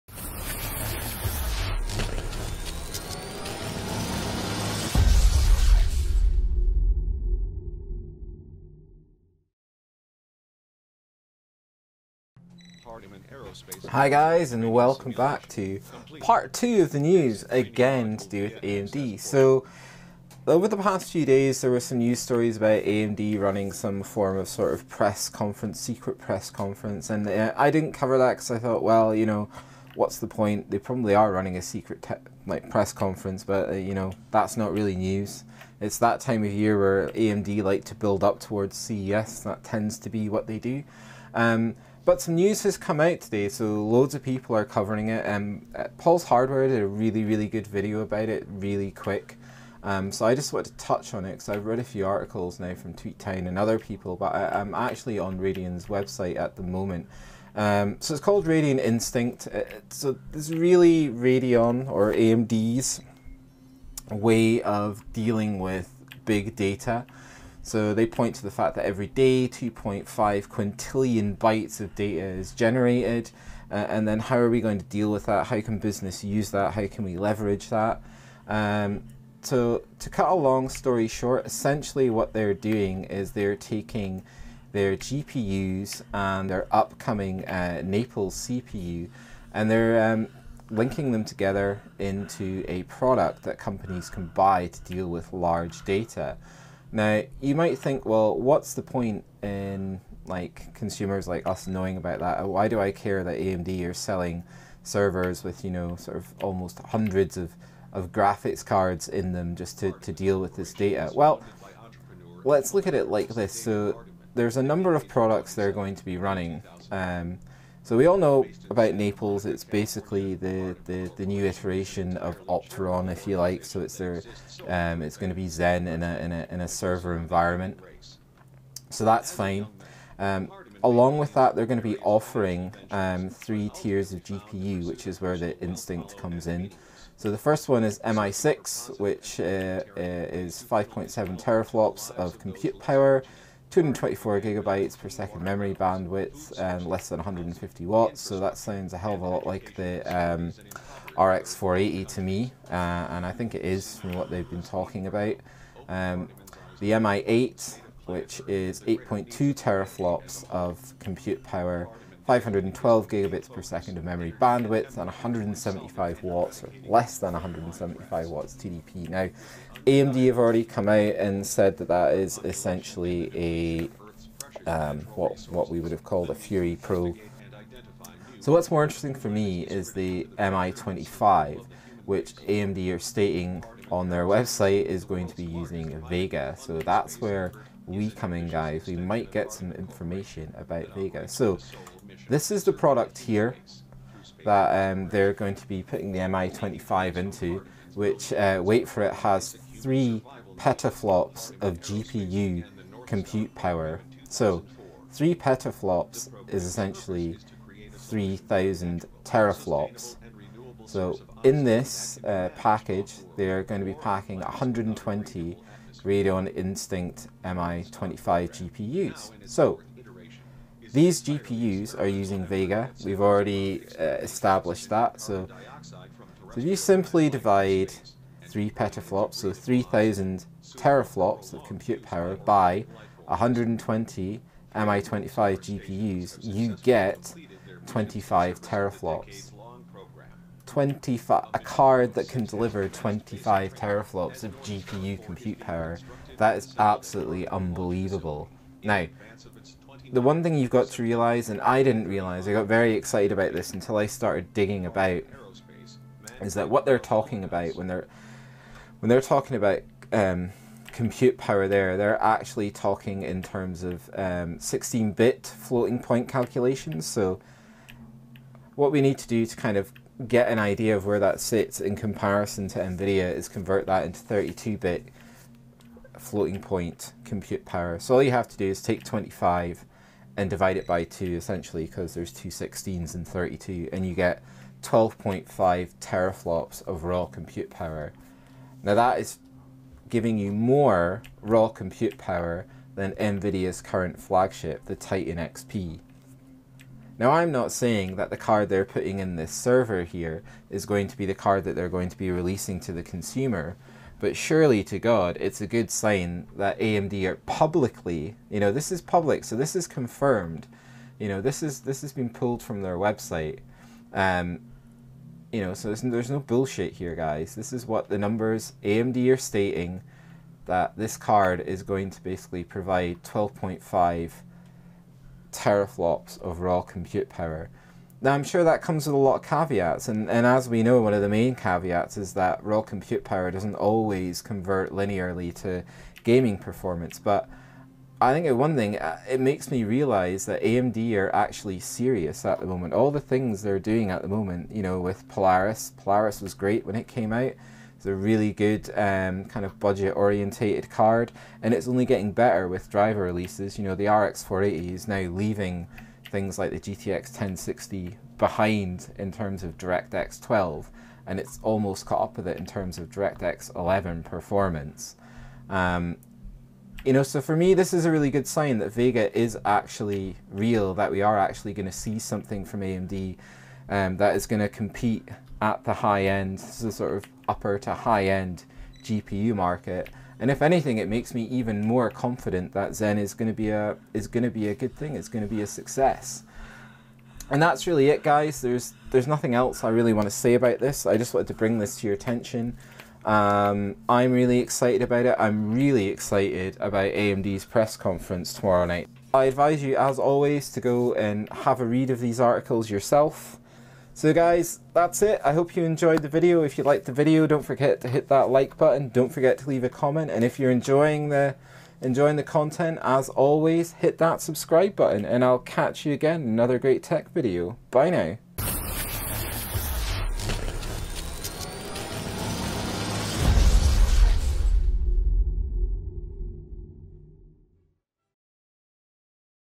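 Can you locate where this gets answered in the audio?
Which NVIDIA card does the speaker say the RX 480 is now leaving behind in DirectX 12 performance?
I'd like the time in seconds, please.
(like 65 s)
356 s.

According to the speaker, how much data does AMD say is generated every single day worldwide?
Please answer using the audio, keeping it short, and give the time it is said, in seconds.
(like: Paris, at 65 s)
2.5 quintillion bytes, at 69 s.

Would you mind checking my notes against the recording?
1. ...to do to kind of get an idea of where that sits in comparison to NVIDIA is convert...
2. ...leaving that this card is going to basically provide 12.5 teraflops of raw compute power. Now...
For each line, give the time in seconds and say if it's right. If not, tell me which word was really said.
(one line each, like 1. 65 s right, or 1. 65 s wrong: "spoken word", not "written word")
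1. 269 s right
2. 319 s wrong: "stating", not "leaving".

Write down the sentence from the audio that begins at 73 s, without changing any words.
Uh, and then how are we going to deal with that?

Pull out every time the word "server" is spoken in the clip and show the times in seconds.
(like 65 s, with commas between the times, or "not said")
104 s, 126 s, 299 s.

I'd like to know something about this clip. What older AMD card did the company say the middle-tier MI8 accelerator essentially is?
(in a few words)
Fury Pro.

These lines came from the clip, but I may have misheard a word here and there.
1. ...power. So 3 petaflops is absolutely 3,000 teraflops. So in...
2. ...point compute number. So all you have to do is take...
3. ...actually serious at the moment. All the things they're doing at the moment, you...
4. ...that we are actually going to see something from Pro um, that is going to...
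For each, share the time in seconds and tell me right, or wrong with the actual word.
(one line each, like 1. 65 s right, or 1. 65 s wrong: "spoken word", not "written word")
1. 203 s wrong: "essentially", not "absolutely"
2. 276 s wrong: "power", not "number"
3. 341 s right
4. 370 s wrong: "AMD", not "Pro".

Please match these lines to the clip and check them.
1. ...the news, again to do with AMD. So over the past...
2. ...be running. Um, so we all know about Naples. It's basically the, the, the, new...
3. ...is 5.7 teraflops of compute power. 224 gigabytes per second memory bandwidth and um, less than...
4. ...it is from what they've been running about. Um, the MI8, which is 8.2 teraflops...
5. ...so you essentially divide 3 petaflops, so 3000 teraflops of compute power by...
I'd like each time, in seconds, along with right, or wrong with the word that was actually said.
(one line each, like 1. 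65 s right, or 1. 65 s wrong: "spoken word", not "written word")
1. 16 s right
2. 116 s right
3. 140 s right
4. 153 s wrong: "talking", not "running"
5. 225 s wrong: "simply", not "essentially".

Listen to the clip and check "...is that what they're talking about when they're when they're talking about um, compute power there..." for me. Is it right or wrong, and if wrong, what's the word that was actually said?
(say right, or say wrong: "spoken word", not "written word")
right.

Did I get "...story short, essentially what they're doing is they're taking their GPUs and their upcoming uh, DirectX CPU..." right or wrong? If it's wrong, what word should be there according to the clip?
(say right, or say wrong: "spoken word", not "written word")
wrong: "Naples", not "DirectX".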